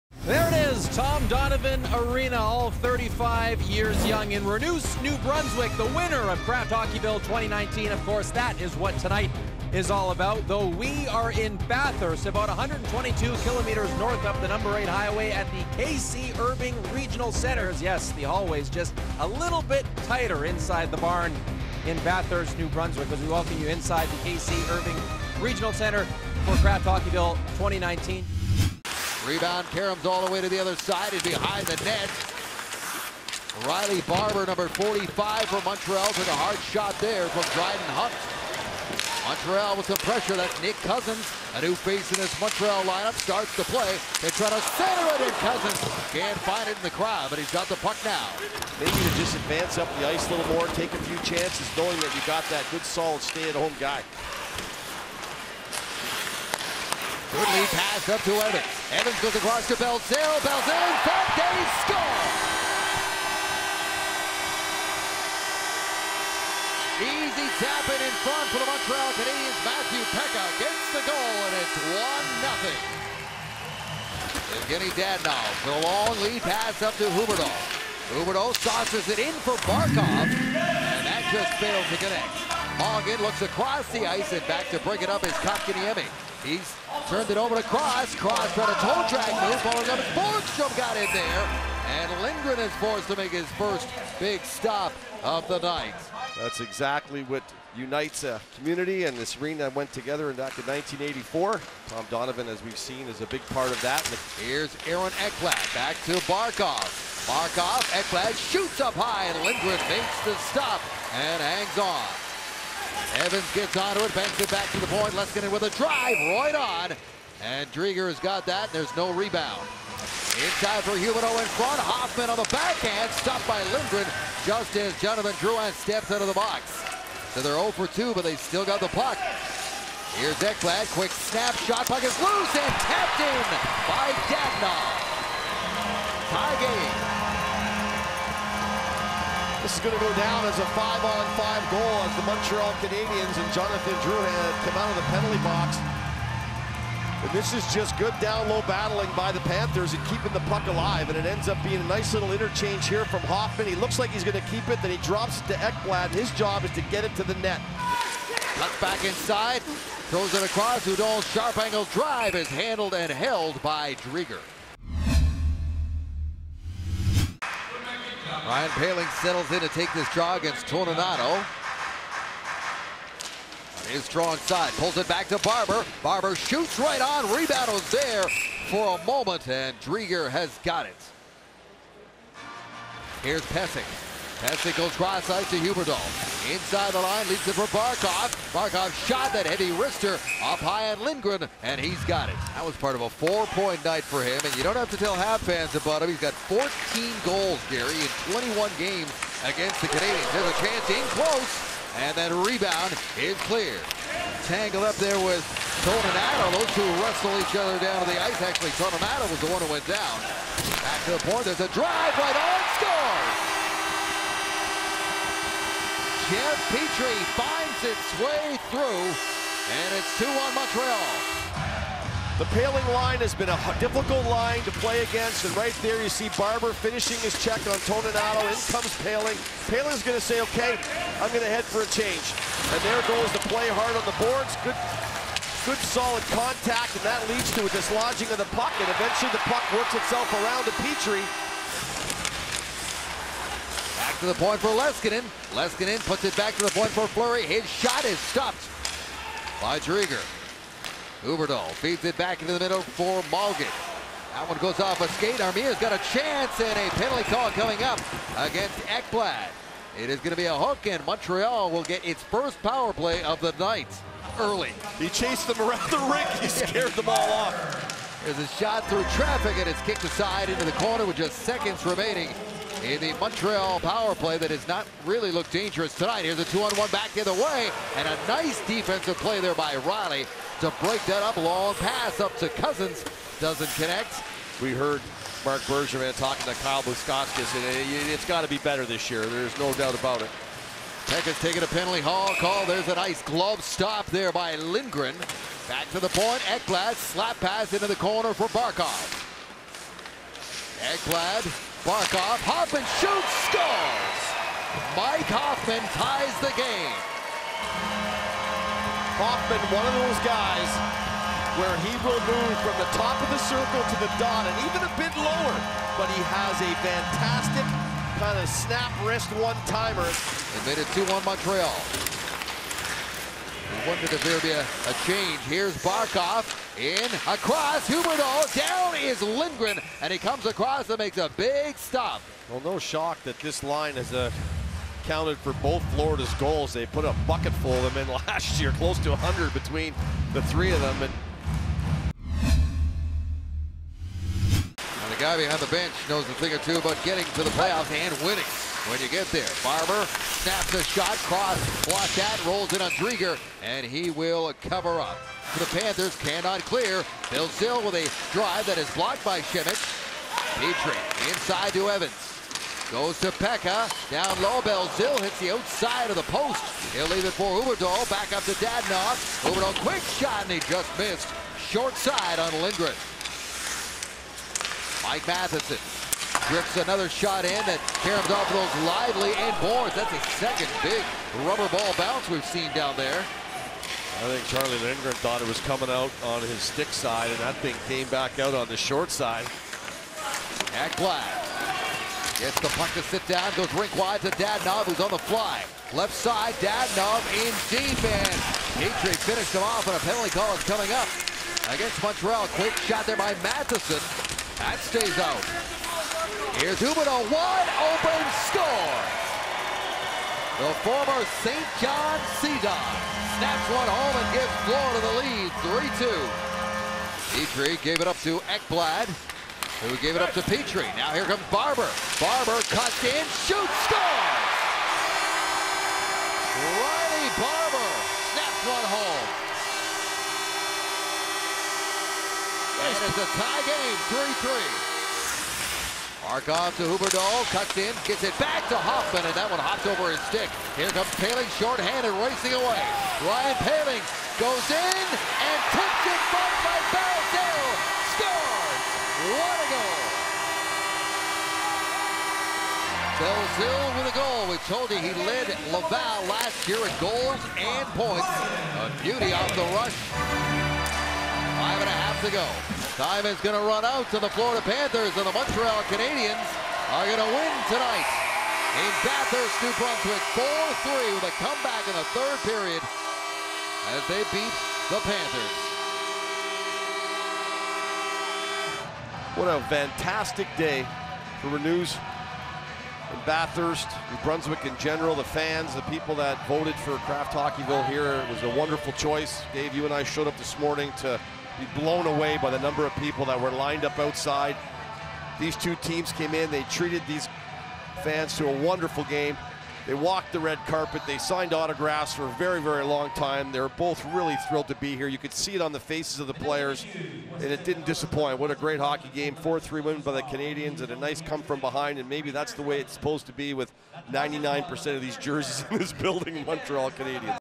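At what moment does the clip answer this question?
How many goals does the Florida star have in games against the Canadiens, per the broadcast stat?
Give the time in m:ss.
3:16.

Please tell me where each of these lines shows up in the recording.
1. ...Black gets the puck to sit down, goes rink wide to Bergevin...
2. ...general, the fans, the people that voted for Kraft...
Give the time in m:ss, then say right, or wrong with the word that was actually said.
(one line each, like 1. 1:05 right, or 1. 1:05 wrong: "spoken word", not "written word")
1. 6:30 wrong: "Dadonov", not "Bergevin"
2. 8:04 right.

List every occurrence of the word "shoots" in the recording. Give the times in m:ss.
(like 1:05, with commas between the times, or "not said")
1:48, 2:56, 5:03, 7:03.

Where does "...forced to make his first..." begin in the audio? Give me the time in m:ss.
1:32.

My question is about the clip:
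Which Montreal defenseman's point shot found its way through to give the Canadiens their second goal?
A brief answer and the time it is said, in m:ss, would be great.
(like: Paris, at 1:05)
Jeff Petry, at 3:36.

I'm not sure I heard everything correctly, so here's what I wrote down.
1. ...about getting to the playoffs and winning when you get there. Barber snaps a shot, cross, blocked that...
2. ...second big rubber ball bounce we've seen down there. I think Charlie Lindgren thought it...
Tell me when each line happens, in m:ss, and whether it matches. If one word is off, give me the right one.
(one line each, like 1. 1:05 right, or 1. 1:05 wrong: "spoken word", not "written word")
1. 5:46 right
2. 6:20 right.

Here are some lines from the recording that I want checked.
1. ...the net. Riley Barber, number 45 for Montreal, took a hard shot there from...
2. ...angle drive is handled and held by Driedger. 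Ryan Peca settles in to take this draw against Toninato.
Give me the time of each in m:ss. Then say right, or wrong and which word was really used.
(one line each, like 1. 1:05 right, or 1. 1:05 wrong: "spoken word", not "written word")
1. 0:31 right
2. 2:41 wrong: "Poehling", not "Peca".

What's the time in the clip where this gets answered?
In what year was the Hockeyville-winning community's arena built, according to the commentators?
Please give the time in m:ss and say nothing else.
1:40.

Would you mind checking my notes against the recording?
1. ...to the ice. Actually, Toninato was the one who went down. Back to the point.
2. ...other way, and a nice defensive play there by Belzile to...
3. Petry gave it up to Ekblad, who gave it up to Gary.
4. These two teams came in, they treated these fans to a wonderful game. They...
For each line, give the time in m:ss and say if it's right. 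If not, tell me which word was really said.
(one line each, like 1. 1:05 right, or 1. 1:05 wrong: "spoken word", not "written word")
1. 3:28 right
2. 4:37 wrong: "Riley", not "Belzile"
3. 6:57 wrong: "Petry", not "Gary"
4. 8:15 right.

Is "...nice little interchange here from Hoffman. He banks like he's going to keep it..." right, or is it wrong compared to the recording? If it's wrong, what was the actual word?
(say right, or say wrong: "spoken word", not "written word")
wrong: "looks", not "banks".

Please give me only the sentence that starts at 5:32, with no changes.
Well, no shock that this line has uh, counted for both Florida's goals.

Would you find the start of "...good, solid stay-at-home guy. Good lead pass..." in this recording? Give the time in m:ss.
0:52.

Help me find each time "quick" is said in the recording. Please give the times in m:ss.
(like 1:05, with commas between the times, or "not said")
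2:10, 6:09, 6:42.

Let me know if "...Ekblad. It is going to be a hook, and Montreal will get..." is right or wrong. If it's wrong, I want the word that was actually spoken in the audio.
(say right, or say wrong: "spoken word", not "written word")
right.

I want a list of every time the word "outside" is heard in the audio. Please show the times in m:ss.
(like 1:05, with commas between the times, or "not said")
6:05, 8:13.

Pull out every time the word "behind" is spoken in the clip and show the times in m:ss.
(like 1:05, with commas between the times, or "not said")
0:31, 5:45, 8:31.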